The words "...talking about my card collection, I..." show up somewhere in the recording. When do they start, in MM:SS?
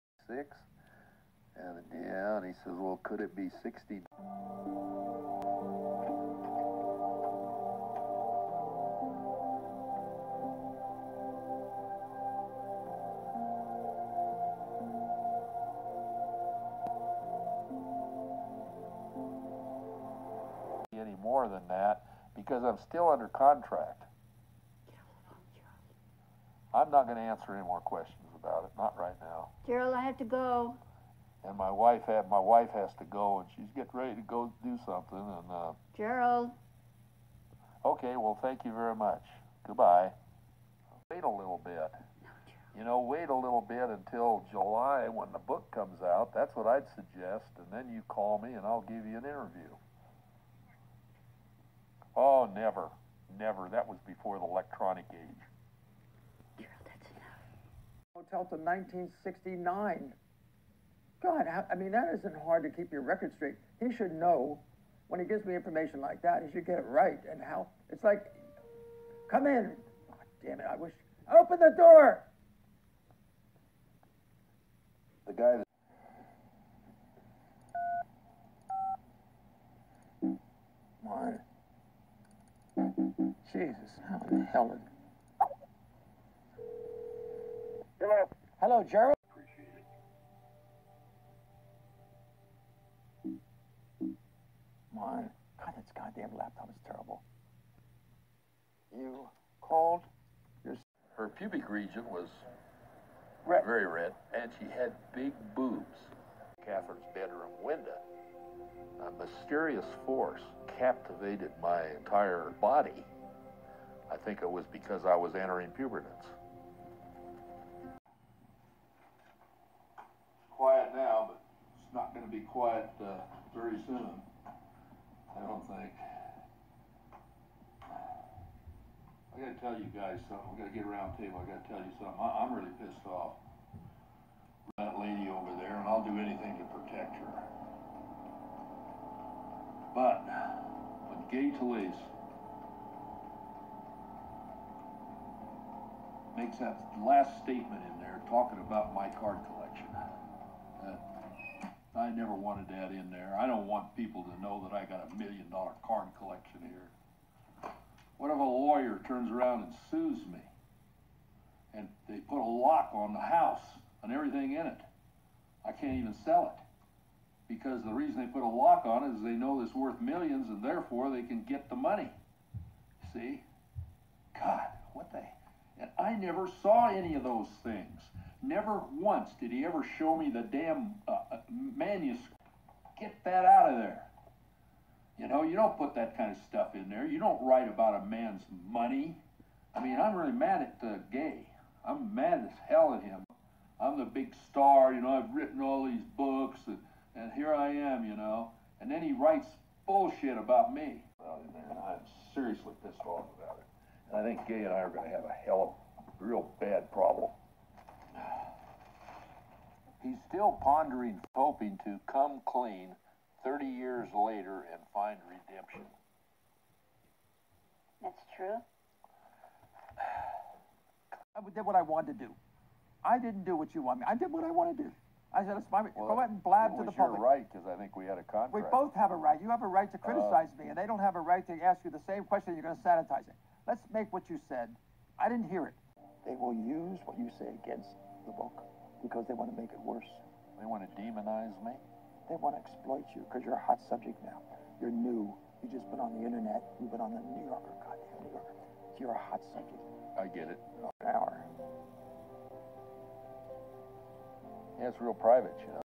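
02:28.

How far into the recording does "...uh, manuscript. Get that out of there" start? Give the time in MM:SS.
03:01.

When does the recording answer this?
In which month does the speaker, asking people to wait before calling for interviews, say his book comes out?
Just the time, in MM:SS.
00:44.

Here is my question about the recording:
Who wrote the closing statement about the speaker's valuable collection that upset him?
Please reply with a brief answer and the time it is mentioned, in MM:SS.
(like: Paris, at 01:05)
Gay Talese, at 02:21.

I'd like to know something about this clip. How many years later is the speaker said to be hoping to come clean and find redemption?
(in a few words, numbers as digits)
30.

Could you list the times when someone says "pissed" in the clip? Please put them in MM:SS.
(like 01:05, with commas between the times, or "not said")
02:12, 03:22.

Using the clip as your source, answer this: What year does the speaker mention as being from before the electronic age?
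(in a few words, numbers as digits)
1969.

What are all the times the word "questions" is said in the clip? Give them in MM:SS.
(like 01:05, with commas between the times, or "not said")
00:27, 03:52.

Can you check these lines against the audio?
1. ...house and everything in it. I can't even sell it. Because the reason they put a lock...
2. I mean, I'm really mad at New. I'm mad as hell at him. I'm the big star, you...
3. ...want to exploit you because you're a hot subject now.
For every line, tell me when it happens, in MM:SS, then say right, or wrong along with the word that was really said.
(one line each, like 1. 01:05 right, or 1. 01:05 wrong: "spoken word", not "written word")
1. 02:43 right
2. 03:09 wrong: "Gay", not "New"
3. 04:02 right.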